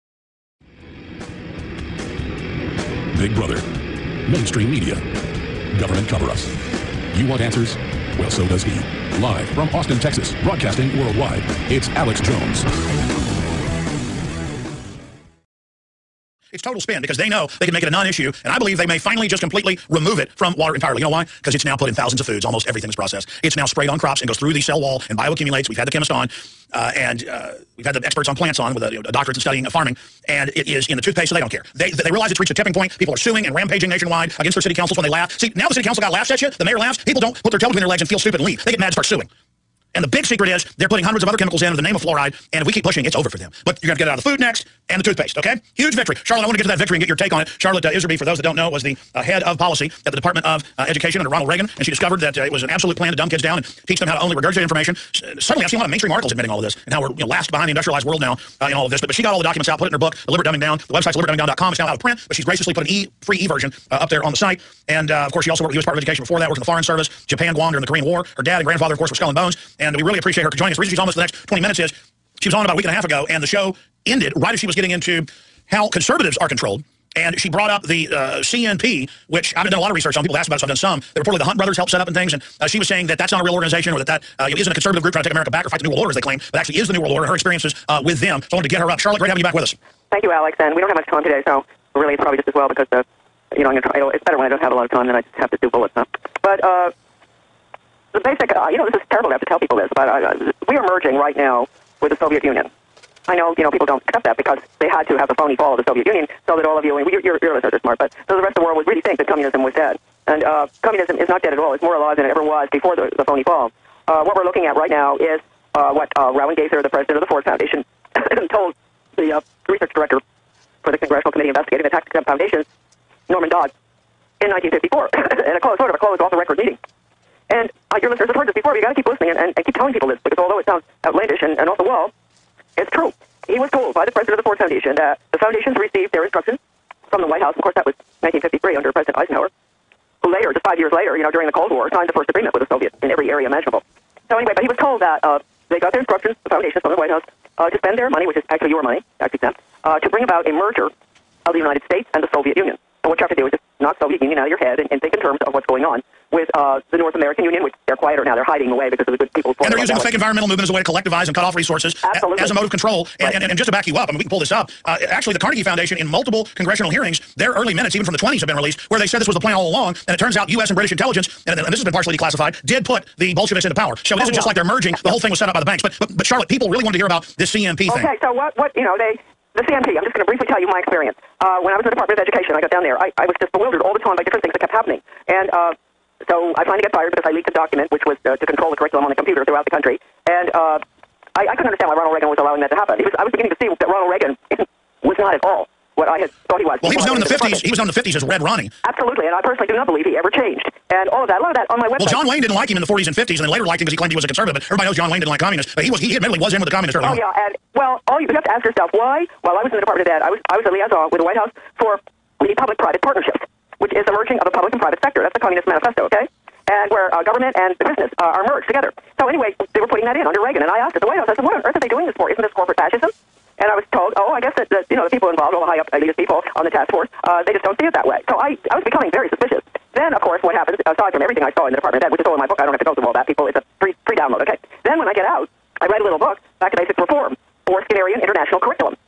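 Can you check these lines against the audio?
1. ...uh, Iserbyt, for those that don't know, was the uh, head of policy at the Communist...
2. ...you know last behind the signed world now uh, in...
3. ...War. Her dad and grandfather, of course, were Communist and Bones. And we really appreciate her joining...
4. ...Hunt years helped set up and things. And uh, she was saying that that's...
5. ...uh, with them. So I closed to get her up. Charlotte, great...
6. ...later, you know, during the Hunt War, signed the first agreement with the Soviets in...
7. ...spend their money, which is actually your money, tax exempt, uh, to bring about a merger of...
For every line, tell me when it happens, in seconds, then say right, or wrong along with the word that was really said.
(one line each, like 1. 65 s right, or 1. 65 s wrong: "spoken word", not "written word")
1. 47 s wrong: "Department", not "Communist"
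2. 57 s wrong: "industrialized", not "signed"
3. 68 s wrong: "Skull", not "Communist"
4. 81 s wrong: "brothers", not "years"
5. 87 s wrong: "wanted", not "closed"
6. 140 s wrong: "Cold", not "Hunt"
7. 147 s right.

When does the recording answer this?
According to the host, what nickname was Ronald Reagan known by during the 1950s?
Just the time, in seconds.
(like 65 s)
198 s.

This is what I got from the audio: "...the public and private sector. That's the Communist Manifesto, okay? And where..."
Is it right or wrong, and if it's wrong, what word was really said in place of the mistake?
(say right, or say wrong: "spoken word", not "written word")
right.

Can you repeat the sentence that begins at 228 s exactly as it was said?
So I, I was becoming very suspicious.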